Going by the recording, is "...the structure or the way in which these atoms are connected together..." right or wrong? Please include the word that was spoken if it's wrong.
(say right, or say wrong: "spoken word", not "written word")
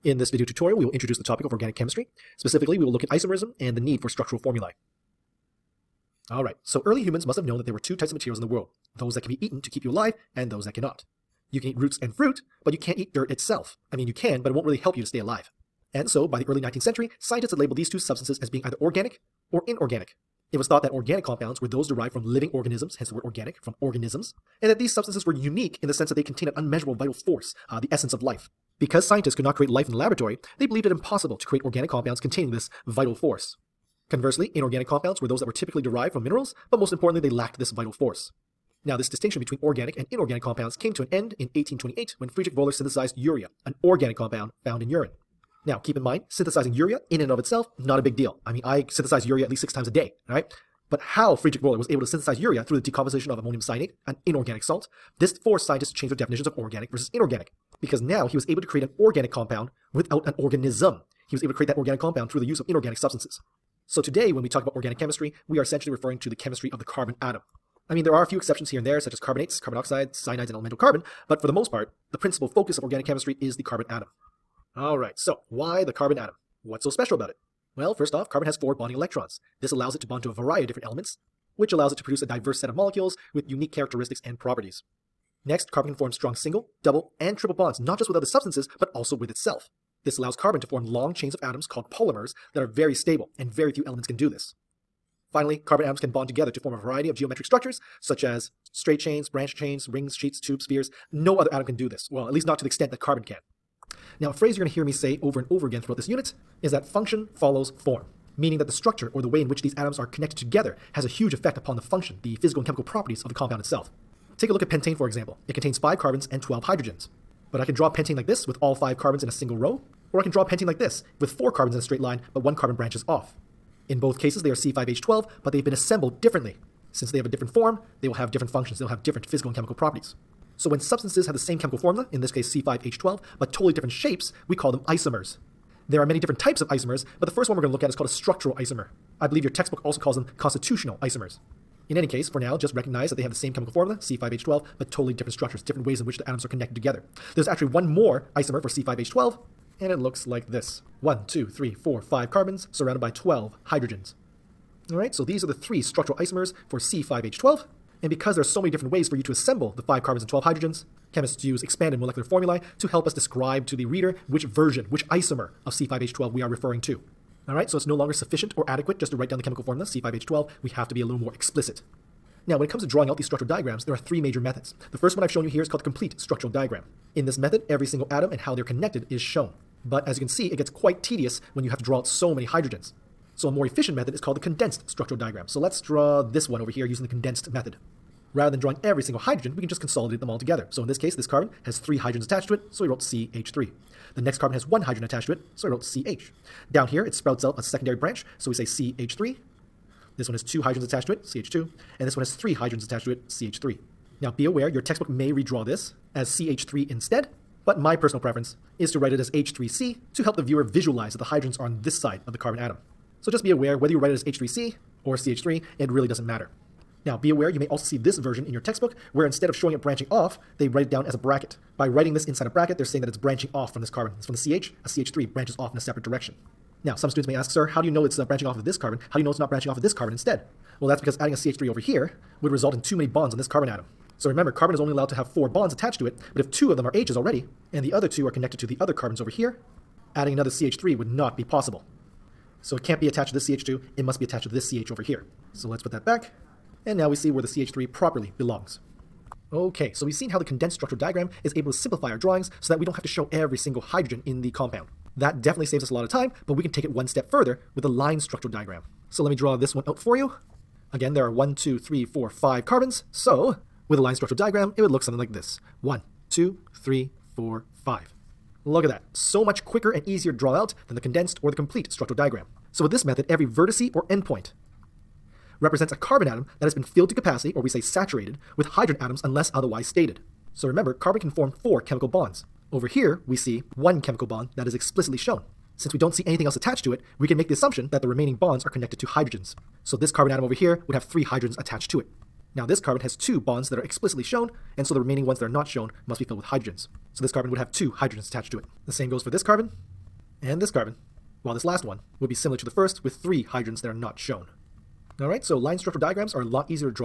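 right.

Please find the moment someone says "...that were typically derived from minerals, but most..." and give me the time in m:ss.
0:35.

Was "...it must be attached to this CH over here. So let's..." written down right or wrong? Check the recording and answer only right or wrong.
right.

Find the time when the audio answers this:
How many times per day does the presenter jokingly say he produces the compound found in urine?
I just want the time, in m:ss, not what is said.
0:49.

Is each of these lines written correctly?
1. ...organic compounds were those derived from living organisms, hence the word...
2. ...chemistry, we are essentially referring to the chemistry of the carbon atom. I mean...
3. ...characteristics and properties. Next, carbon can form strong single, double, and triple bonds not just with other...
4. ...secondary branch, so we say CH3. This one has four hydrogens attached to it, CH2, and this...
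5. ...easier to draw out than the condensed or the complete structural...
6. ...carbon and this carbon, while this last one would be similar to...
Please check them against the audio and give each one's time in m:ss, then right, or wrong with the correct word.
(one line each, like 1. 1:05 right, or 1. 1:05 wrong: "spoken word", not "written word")
1. 0:20 right
2. 1:04 right
3. 1:23 right
4. 3:17 wrong: "two", not "four"
5. 4:30 right
6. 4:59 right.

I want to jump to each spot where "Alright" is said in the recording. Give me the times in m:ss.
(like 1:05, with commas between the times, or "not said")
0:06, 1:14.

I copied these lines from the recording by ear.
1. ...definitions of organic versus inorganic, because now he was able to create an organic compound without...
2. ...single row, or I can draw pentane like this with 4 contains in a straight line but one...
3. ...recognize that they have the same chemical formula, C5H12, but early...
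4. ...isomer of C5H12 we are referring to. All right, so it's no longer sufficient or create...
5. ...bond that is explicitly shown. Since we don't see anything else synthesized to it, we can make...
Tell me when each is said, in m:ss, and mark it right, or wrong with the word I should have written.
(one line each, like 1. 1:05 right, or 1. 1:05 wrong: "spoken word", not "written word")
1. 0:56 right
2. 1:59 wrong: "carbons", not "contains"
3. 2:22 wrong: "totally", not "early"
4. 2:45 wrong: "adequate", not "create"
5. 4:44 wrong: "attached", not "synthesized".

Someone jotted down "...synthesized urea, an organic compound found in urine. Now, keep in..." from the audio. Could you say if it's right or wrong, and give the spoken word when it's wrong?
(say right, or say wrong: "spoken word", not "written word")
right.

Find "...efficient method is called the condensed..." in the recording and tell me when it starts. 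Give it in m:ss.
3:03.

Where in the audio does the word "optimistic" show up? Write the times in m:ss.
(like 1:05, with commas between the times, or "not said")
not said.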